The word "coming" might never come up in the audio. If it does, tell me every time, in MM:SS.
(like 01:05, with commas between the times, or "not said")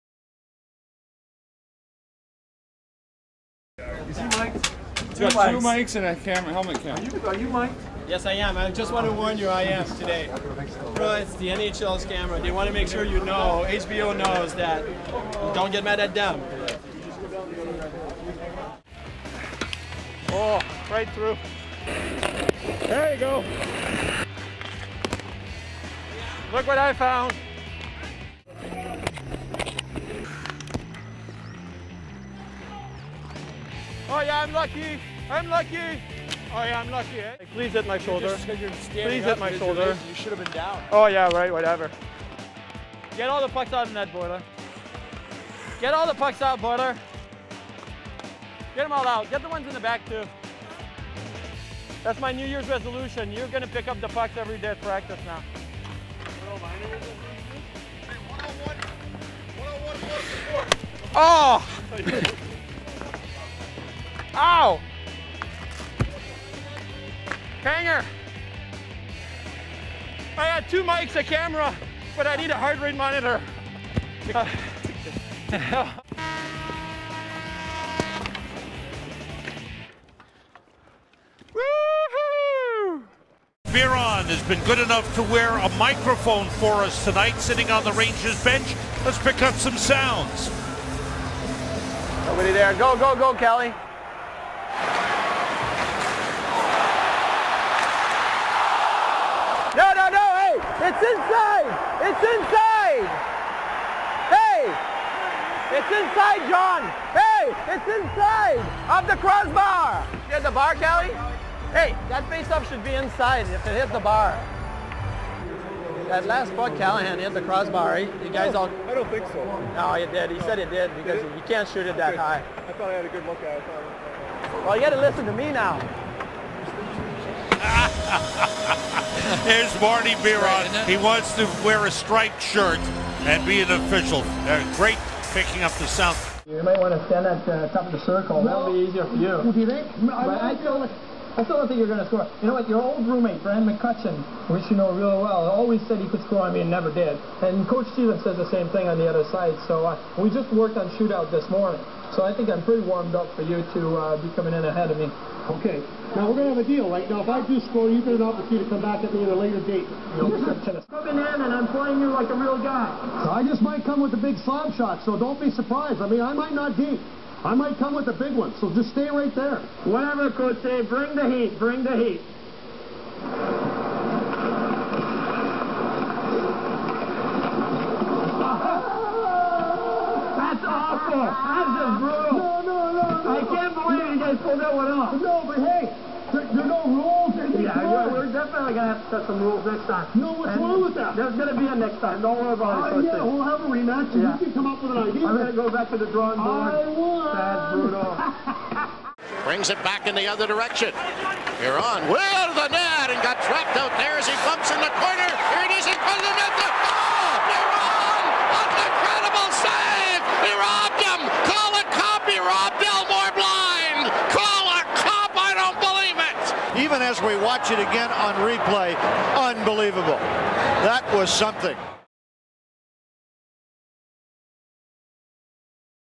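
02:34, 02:40.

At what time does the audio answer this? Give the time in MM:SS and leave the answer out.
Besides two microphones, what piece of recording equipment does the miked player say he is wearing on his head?
00:06.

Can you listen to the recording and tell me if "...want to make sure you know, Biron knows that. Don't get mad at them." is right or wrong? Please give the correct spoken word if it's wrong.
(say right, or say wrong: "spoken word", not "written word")
wrong: "HBO", not "Biron".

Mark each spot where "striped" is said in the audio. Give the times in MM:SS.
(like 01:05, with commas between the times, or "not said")
02:11.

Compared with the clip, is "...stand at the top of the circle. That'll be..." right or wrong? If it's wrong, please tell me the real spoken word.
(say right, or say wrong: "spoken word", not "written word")
right.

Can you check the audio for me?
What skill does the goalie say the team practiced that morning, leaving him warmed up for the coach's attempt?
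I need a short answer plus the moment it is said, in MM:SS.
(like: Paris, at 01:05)
Shootout, at 02:30.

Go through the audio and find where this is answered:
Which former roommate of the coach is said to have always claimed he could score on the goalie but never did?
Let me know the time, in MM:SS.
02:23.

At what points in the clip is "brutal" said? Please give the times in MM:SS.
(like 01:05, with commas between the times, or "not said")
03:01, 03:17.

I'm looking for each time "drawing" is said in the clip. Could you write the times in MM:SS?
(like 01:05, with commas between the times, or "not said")
03:16.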